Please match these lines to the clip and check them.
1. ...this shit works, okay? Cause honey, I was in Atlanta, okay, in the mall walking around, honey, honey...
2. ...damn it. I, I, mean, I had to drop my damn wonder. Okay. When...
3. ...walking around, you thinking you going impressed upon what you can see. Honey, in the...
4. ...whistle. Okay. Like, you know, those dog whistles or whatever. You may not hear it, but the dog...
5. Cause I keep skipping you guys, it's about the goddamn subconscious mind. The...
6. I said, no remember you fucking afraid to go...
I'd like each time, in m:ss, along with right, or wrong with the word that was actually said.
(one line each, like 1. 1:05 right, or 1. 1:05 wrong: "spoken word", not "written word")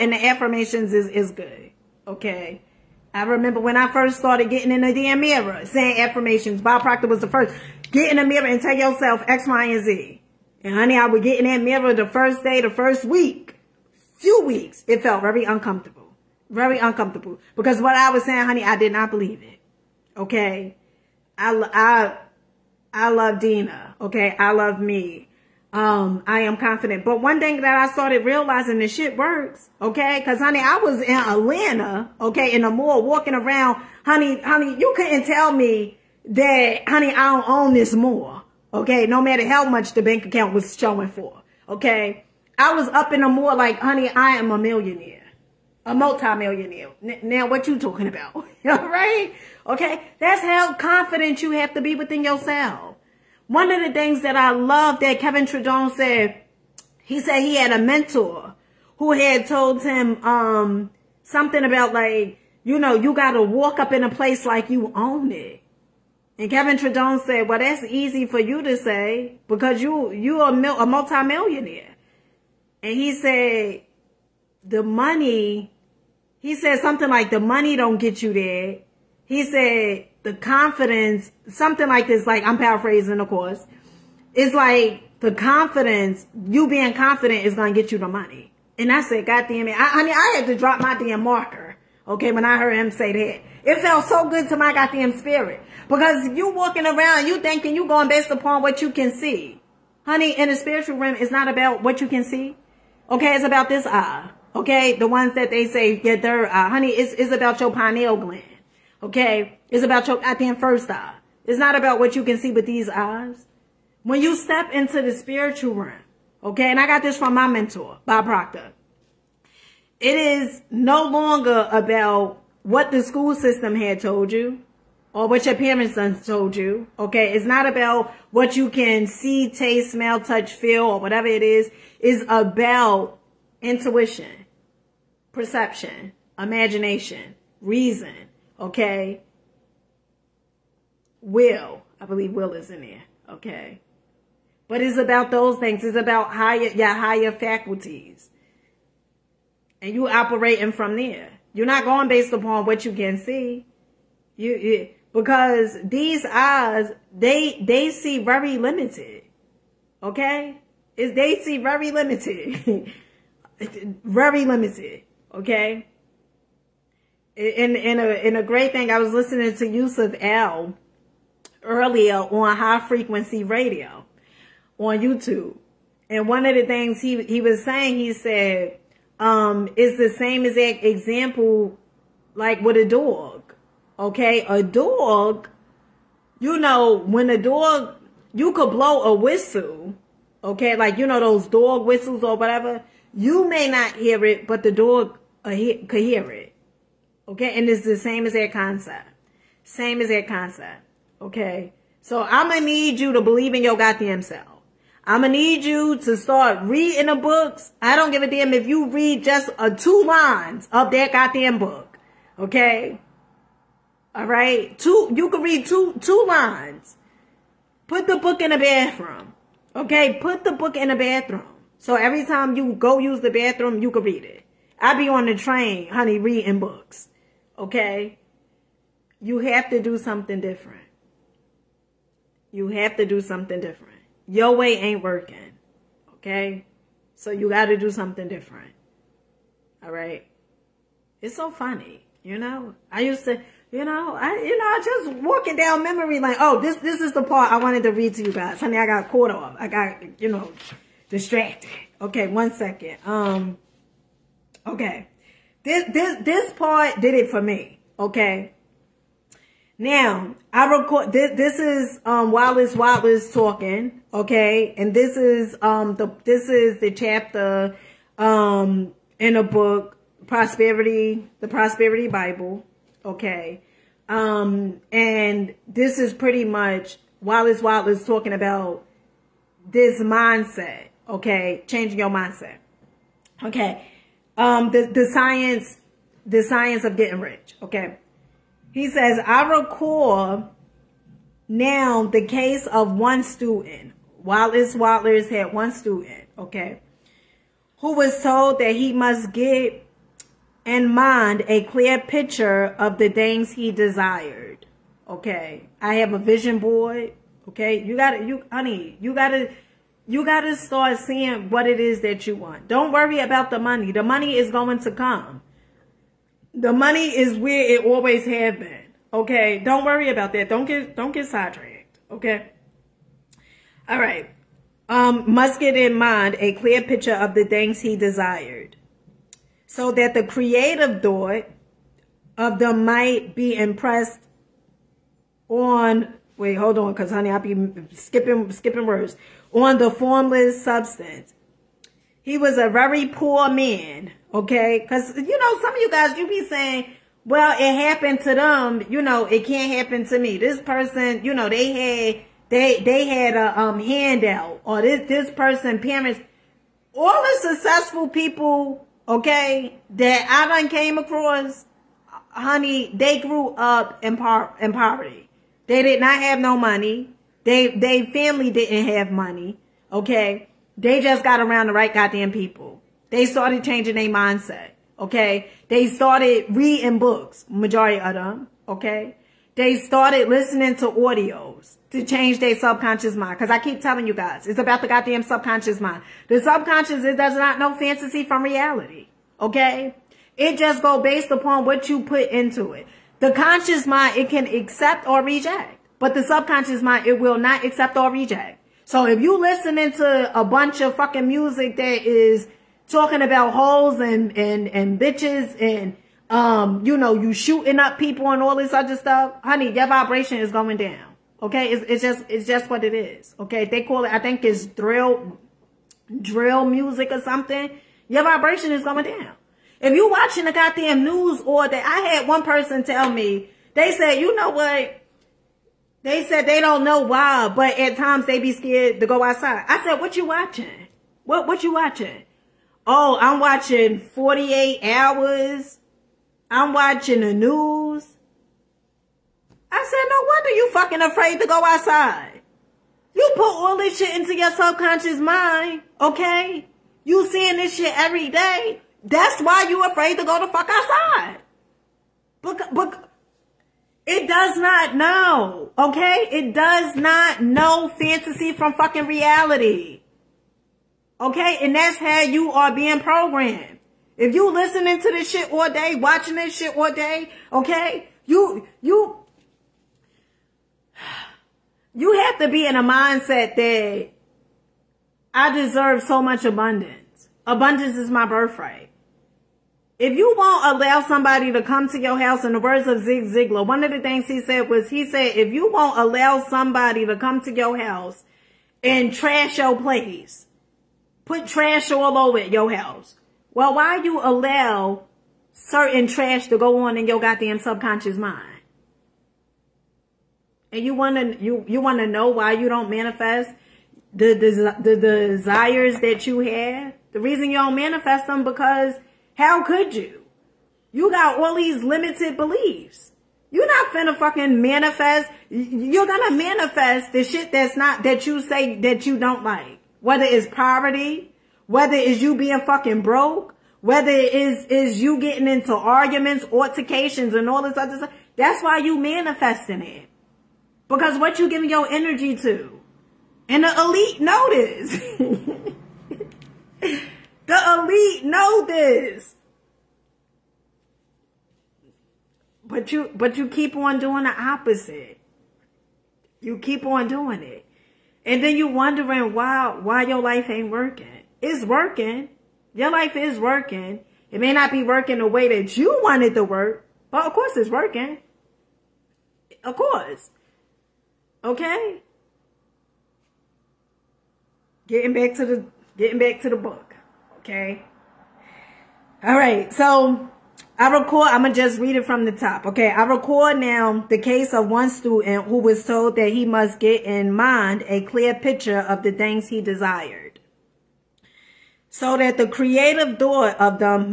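1. 0:28 right
2. 1:29 wrong: "marker", not "wonder"
3. 1:36 wrong: "based", not "impressed"
4. 3:09 right
5. 6:23 wrong: "telling", not "skipping"
6. 7:19 wrong: "wonder", not "remember".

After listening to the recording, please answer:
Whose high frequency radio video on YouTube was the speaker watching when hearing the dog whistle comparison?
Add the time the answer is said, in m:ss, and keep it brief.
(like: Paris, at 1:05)
Yusuf L, at 2:49.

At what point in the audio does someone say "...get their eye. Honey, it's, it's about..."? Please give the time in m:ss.
1:45.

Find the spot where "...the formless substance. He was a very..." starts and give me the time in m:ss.
5:39.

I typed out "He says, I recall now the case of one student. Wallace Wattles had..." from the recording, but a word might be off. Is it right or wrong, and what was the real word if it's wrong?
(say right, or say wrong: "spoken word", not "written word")
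right.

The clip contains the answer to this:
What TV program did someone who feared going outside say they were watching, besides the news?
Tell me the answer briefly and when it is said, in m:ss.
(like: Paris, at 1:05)
48 Hours, at 7:13.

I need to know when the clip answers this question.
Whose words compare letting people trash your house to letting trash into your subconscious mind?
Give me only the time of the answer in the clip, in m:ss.
8:03.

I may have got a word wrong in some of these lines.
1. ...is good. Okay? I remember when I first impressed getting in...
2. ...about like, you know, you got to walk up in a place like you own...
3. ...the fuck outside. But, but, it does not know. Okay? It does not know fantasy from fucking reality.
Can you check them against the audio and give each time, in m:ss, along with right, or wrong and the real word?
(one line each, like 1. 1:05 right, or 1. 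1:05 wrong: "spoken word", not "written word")
1. 0:01 wrong: "started", not "impressed"
2. 1:01 right
3. 7:30 right.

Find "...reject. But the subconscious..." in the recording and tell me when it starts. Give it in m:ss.
6:35.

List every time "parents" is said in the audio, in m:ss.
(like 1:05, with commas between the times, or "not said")
2:05, 5:55.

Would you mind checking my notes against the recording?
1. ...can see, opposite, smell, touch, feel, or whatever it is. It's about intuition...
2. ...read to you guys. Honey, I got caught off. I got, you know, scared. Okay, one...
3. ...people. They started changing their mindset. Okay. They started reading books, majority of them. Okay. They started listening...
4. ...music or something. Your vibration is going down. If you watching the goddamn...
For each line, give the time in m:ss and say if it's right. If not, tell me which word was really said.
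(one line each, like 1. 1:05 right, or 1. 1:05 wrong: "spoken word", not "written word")
1. 2:08 wrong: "taste", not "opposite"
2. 4:07 wrong: "distracted", not "scared"
3. 6:12 right
4. 6:56 right.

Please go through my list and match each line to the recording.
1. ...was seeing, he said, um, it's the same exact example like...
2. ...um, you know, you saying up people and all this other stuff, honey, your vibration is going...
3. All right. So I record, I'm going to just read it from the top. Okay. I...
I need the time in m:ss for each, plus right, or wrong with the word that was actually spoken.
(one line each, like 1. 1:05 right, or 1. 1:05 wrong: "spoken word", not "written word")
1. 2:57 wrong: "saying", not "seeing"
2. 6:46 wrong: "shooting", not "saying"
3. 9:29 right.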